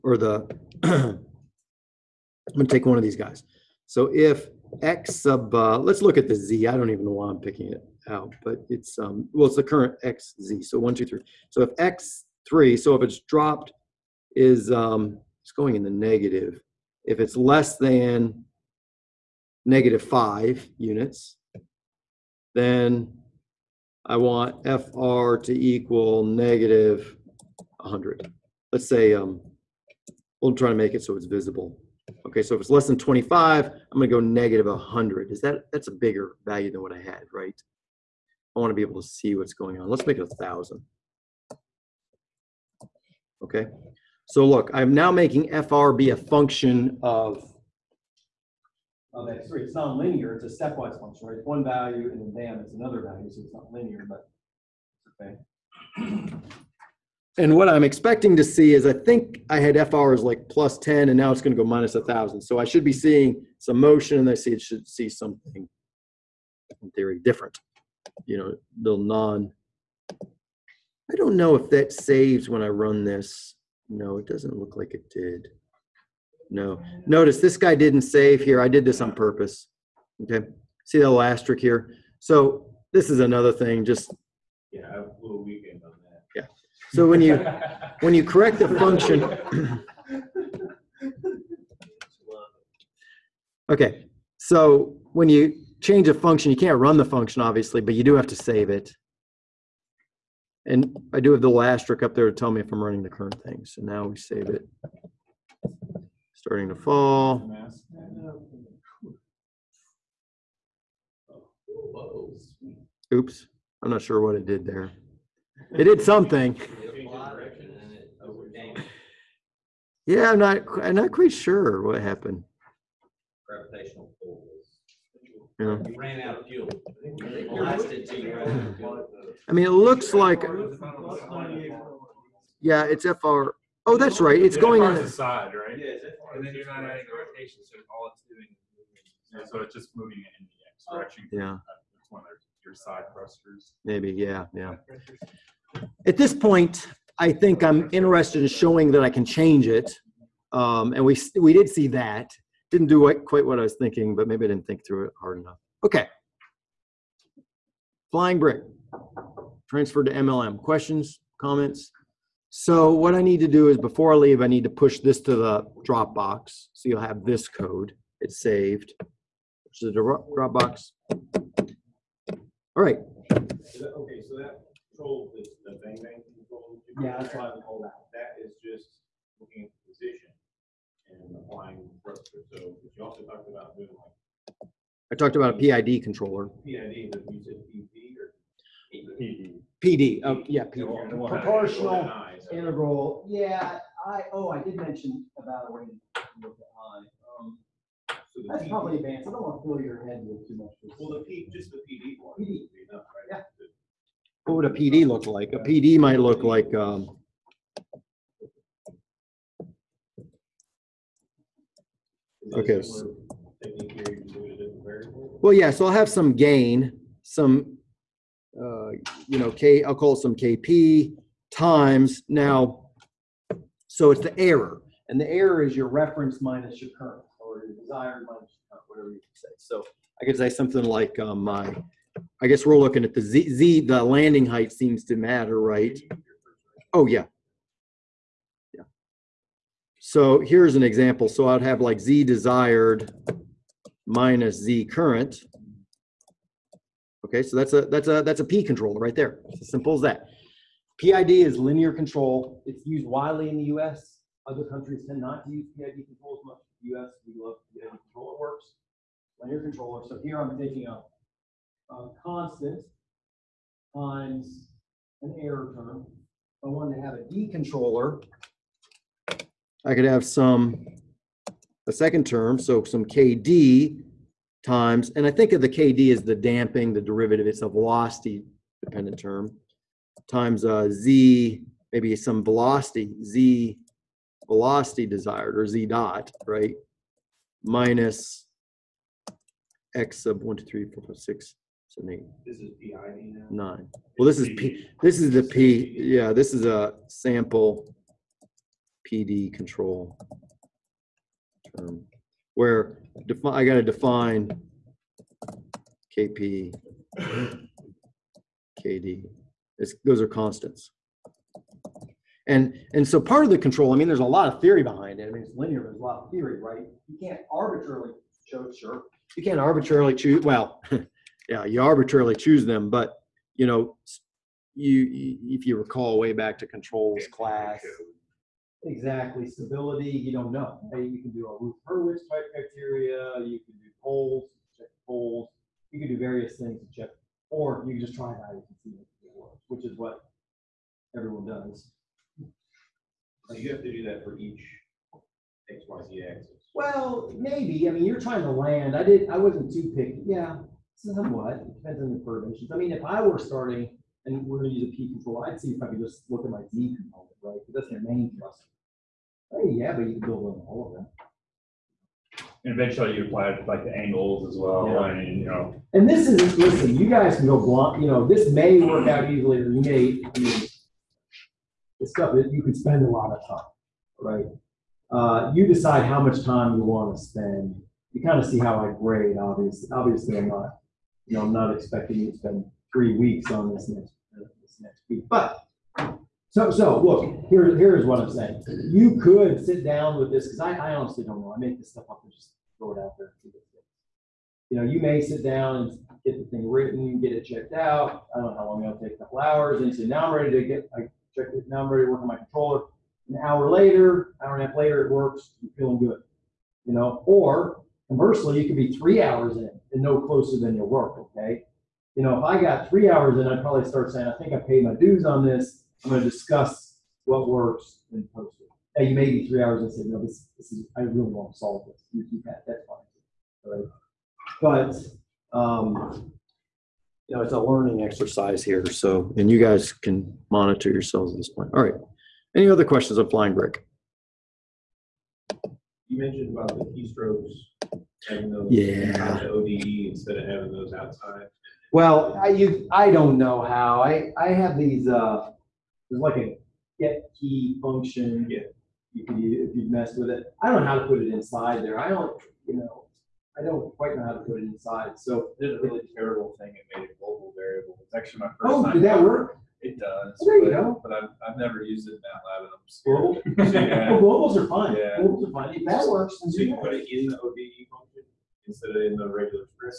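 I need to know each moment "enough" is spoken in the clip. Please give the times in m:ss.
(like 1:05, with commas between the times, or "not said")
2:35, 3:22.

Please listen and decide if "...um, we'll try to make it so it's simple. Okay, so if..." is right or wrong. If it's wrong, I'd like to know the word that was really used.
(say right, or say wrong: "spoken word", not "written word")
wrong: "visible", not "simple".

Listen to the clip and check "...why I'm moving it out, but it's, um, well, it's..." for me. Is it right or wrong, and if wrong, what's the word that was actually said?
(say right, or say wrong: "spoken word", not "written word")
wrong: "picking", not "moving".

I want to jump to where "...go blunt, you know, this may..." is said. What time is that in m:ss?
6:07.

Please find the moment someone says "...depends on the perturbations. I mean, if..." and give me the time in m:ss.
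5:51.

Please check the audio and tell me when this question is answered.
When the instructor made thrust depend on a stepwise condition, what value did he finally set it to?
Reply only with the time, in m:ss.
0:39.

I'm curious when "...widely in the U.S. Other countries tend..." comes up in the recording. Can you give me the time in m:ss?
4:13.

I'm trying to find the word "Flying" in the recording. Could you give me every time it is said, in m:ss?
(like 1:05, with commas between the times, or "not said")
2:38, 7:13.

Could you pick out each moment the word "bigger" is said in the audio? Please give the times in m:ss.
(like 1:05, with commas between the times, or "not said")
0:35.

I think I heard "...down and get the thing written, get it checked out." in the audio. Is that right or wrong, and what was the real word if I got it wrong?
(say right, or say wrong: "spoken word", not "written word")
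right.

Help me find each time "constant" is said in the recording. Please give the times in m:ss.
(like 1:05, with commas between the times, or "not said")
4:22, 5:10.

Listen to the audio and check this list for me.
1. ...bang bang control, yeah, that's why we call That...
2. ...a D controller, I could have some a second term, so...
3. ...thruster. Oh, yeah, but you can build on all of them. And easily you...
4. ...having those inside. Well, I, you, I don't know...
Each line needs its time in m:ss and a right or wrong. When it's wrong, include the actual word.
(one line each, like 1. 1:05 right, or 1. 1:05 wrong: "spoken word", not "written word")
1. 2:55 right
2. 4:27 right
3. 5:58 wrong: "eventually", not "easily"
4. 7:20 wrong: "outside", not "inside".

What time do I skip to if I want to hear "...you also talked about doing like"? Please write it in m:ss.
3:02.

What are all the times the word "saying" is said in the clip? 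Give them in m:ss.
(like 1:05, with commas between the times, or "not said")
6:28, 6:54.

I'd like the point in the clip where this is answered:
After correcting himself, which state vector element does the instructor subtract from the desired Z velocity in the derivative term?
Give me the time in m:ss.
4:53.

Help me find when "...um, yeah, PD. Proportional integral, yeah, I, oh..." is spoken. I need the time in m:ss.
3:10.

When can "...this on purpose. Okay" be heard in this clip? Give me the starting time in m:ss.
1:18.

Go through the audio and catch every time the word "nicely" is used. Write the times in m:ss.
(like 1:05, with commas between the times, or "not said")
not said.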